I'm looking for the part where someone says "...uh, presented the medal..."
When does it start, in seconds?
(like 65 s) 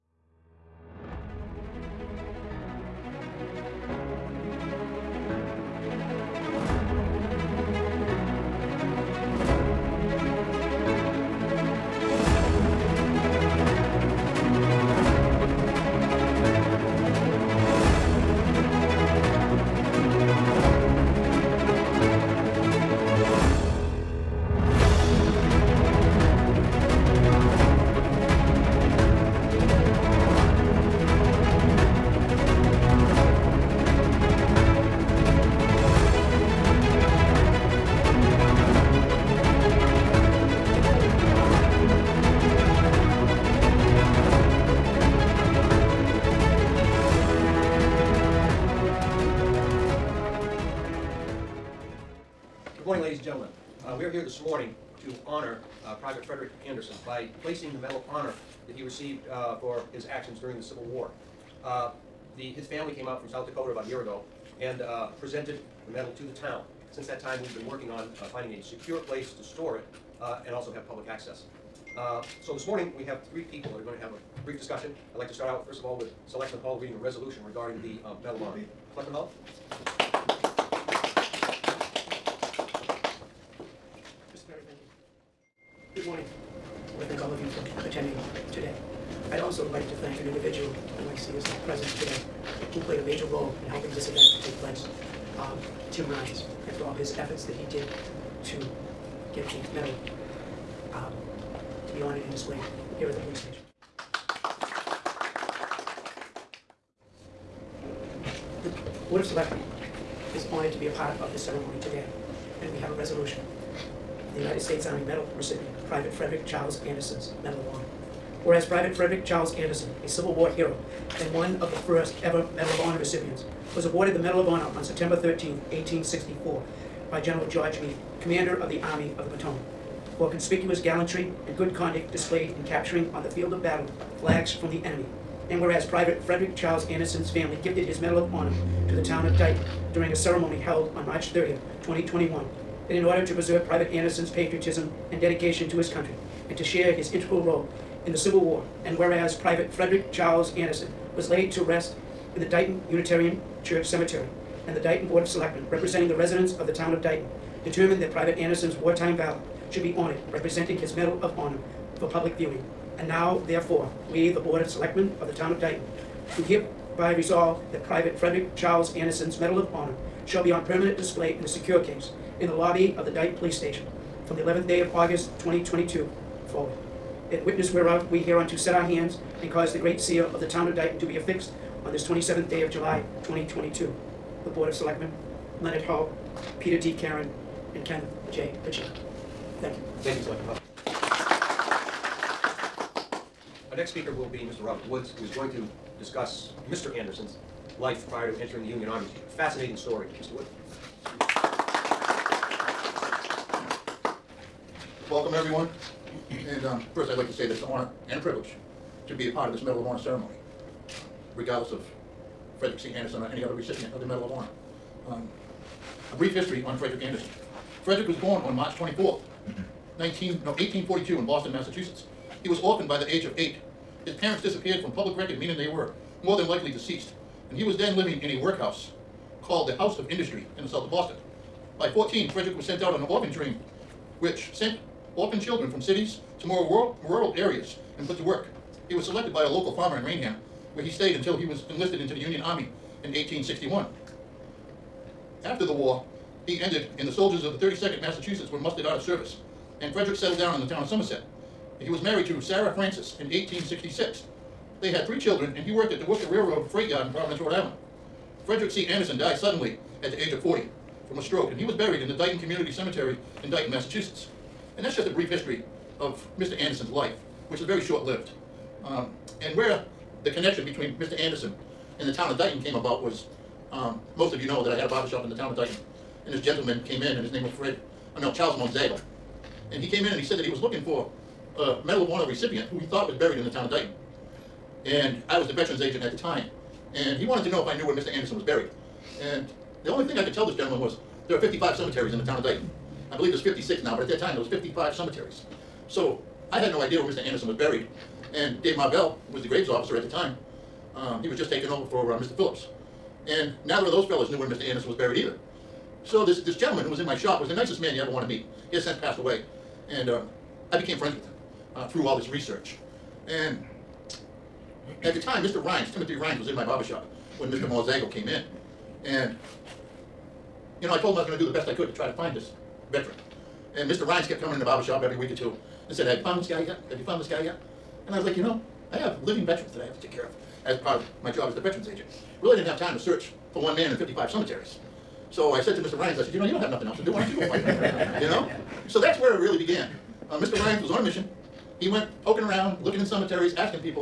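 64 s.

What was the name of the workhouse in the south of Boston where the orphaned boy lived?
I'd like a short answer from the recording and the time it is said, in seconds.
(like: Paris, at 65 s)
House of Industry, at 229 s.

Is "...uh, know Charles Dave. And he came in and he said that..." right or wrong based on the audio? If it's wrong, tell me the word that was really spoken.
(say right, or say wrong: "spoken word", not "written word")
wrong: "Monzago", not "Dave".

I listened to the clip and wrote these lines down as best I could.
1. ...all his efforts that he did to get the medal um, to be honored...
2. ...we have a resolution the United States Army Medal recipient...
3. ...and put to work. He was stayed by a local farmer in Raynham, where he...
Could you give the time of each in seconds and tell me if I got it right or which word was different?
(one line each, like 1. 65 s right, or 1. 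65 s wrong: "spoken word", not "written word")
1. 96 s right
2. 112 s right
3. 237 s wrong: "selected", not "stayed".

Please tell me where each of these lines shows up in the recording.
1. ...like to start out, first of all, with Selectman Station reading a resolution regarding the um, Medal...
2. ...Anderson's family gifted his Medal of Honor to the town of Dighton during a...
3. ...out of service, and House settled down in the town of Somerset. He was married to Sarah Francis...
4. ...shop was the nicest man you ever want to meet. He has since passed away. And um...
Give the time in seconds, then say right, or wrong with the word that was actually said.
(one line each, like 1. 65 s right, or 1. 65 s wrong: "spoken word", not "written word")
1. 75 s wrong: "Hall", not "Station"
2. 136 s right
3. 248 s wrong: "Frederick", not "House"
4. 307 s right.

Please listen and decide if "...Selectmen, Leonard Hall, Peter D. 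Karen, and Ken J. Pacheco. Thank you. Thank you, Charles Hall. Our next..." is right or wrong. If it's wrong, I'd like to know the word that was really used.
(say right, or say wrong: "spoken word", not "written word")
wrong: "Selectman", not "Charles".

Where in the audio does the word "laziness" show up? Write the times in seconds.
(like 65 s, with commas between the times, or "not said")
not said.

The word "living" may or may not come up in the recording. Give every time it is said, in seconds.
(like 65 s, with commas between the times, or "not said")
227 s, 329 s.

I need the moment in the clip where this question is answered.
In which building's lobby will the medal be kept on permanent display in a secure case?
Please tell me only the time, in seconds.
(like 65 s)
173 s.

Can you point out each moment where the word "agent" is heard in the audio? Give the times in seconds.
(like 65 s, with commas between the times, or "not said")
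285 s, 331 s.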